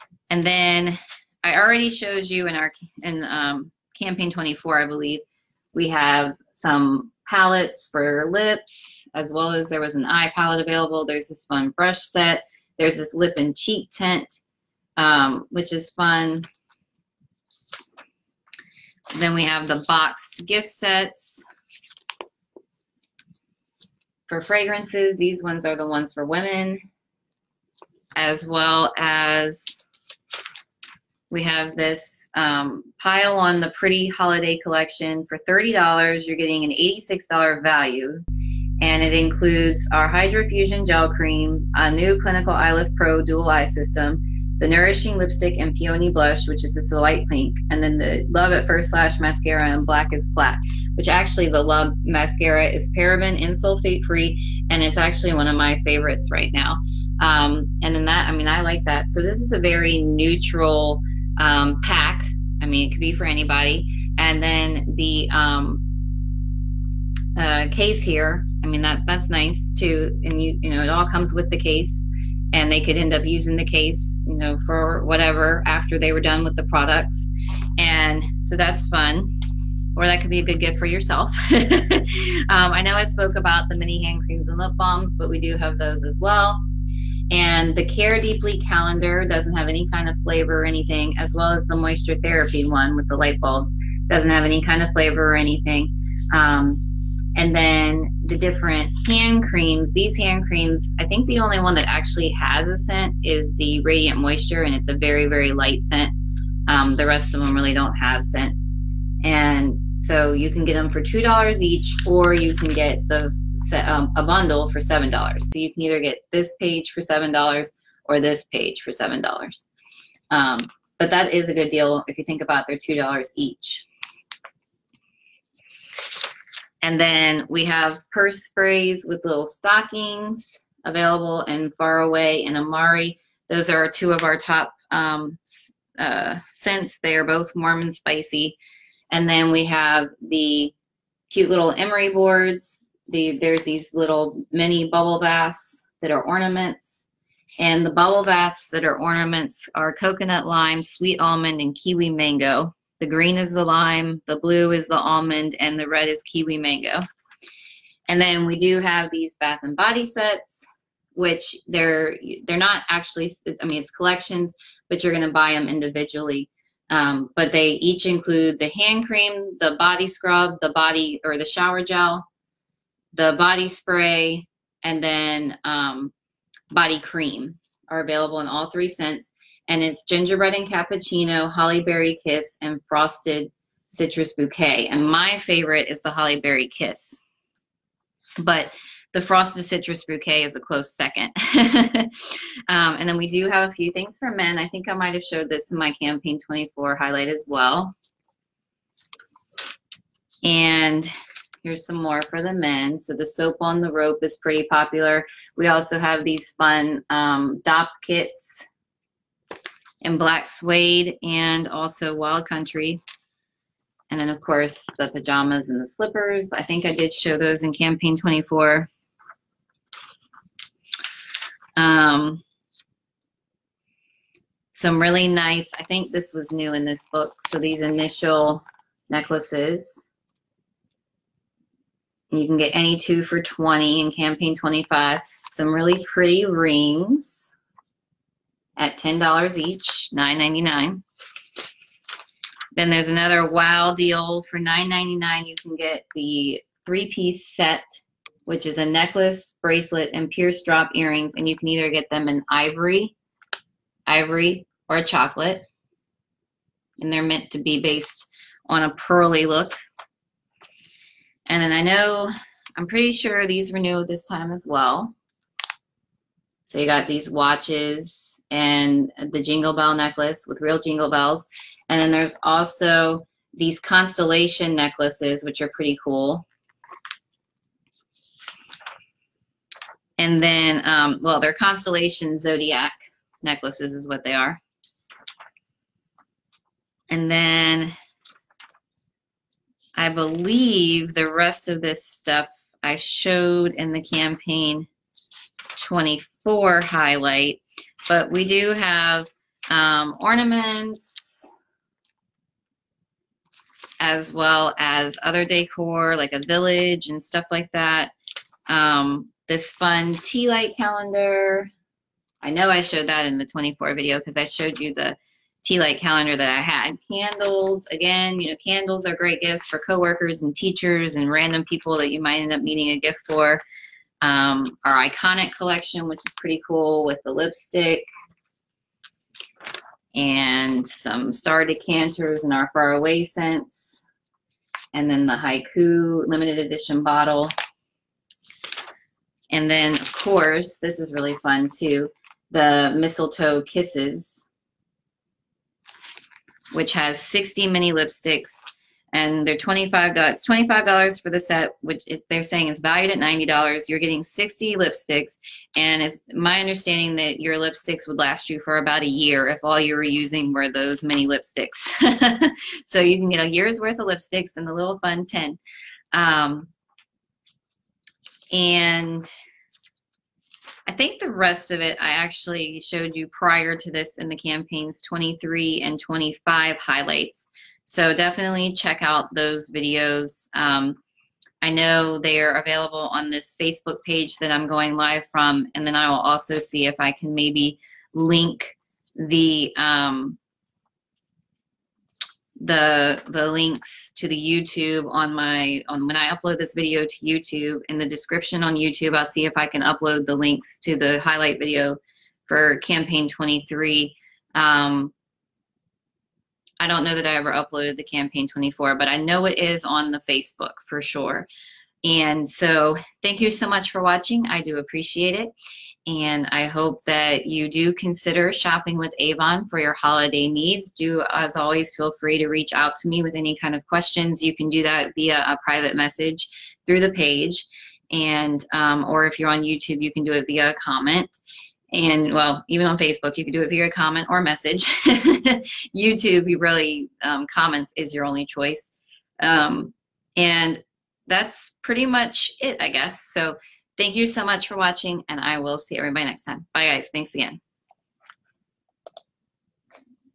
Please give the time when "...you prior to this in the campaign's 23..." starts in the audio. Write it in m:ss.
6:13.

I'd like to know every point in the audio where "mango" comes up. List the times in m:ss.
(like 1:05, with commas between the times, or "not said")
2:32, 2:36.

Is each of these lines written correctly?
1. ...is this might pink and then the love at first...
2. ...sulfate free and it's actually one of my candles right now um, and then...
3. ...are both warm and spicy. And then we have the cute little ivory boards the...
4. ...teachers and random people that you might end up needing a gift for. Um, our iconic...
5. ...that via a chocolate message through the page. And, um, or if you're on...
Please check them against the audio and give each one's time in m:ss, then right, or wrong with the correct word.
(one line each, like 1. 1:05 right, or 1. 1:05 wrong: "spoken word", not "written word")
1. 0:46 wrong: "light", not "might"
2. 0:53 wrong: "favorites", not "candles"
3. 2:17 wrong: "emery", not "ivory"
4. 5:20 right
5. 7:04 wrong: "private", not "chocolate".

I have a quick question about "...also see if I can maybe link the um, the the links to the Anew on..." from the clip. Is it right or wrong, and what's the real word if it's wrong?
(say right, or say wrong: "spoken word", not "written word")
wrong: "YouTube", not "Anew".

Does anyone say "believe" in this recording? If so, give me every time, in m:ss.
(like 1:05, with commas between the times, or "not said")
0:04, 4:50.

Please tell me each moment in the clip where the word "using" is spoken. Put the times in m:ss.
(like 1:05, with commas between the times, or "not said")
1:13, 6:00.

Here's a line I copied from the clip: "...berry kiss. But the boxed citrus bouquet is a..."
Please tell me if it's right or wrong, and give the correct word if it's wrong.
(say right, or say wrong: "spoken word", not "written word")
wrong: "frosted", not "boxed".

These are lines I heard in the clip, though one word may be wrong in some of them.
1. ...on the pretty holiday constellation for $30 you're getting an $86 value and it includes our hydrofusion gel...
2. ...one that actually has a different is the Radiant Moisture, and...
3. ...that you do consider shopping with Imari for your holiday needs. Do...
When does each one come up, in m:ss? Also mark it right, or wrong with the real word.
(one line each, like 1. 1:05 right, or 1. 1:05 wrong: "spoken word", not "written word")
1. 0:33 wrong: "collection", not "constellation"
2. 1:41 wrong: "scent", not "different"
3. 6:57 wrong: "Avon", not "Imari".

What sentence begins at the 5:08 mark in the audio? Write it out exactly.
Um, this fun tea light calendar.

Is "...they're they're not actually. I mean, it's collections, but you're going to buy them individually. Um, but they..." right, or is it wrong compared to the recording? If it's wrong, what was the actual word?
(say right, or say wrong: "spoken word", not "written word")
right.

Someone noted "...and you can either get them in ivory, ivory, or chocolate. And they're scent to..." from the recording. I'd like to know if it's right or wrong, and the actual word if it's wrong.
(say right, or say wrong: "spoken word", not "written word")
wrong: "meant", not "scent".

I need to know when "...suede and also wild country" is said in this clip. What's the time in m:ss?
3:30.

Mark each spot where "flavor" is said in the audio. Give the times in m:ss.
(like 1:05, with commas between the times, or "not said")
1:30, 1:34.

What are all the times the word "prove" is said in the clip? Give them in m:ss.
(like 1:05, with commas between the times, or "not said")
not said.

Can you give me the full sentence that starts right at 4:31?
And then there's also these constellation necklaces, which are pretty cool.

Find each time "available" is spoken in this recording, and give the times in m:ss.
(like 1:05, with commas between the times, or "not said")
0:10, 2:10, 2:57, 6:22.